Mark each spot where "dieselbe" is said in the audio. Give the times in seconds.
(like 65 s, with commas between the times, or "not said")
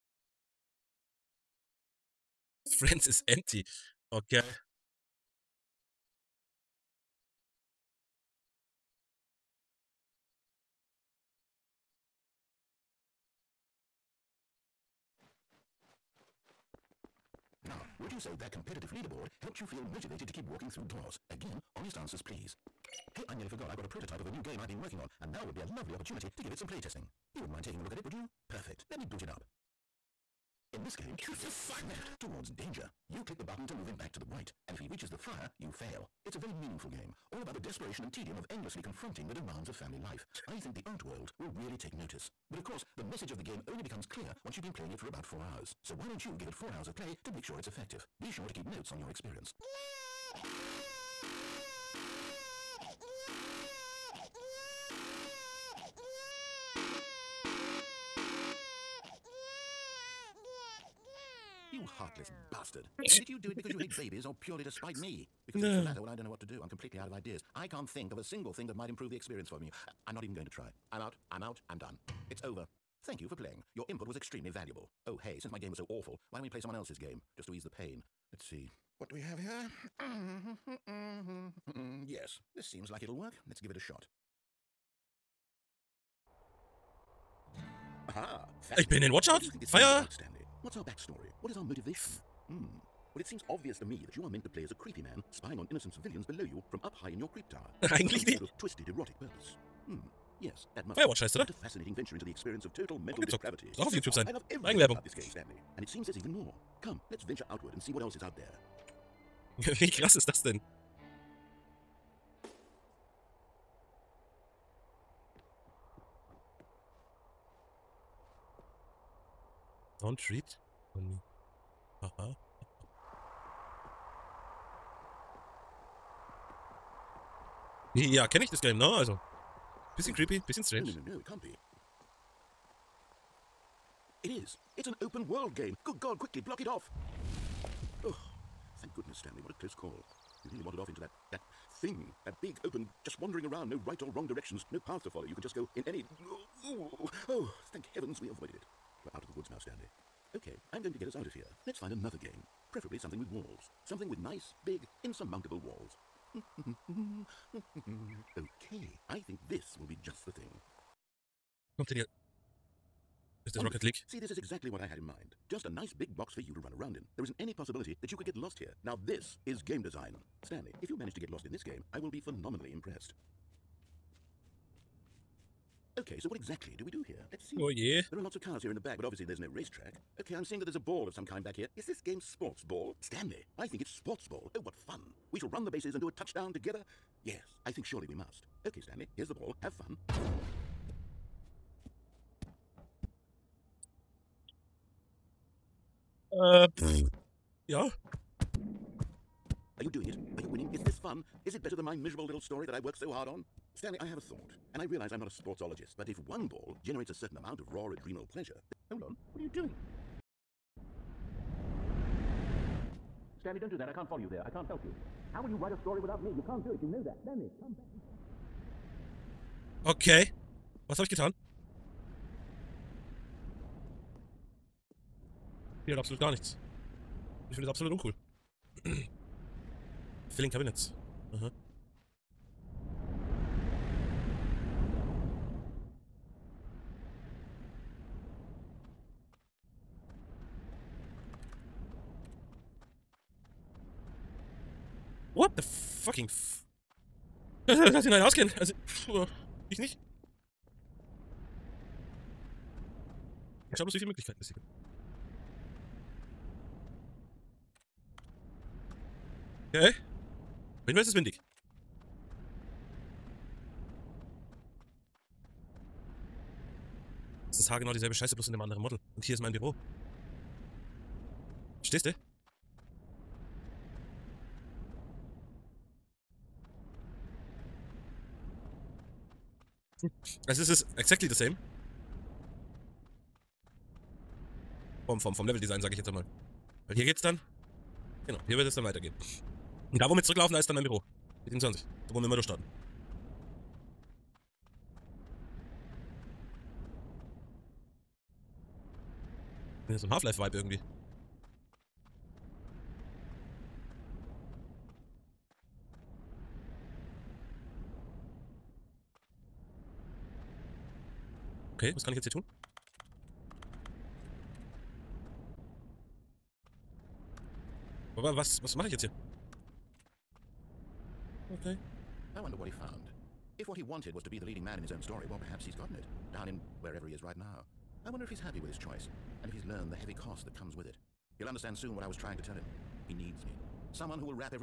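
267 s.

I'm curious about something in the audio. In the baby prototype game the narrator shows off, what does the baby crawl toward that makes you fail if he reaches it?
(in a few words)
The fire.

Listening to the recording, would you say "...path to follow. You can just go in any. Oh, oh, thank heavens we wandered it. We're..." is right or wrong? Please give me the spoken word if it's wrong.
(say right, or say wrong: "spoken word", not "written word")
wrong: "avoided", not "wandered".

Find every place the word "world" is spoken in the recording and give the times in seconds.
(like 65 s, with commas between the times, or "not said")
41 s, 135 s.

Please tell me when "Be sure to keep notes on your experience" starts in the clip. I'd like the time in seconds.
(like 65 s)
48 s.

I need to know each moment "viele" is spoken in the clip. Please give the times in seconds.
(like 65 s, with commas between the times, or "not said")
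253 s.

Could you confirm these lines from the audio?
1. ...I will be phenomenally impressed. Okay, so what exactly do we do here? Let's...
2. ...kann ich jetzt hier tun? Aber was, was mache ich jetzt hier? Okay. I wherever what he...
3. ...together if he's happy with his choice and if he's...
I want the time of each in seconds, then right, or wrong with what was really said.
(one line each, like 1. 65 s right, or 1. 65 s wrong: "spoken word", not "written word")
1. 171 s right
2. 312 s wrong: "wonder", not "wherever"
3. 328 s wrong: "wonder", not "together".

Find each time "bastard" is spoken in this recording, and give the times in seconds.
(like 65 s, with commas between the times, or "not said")
62 s.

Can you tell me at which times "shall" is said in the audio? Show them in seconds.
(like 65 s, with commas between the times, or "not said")
185 s.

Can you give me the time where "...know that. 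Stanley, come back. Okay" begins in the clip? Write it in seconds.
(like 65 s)
216 s.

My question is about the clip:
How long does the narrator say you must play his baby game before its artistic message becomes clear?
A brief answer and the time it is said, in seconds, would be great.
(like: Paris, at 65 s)
About four hours, at 45 s.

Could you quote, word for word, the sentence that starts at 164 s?
See, this is exactly what I had in mind.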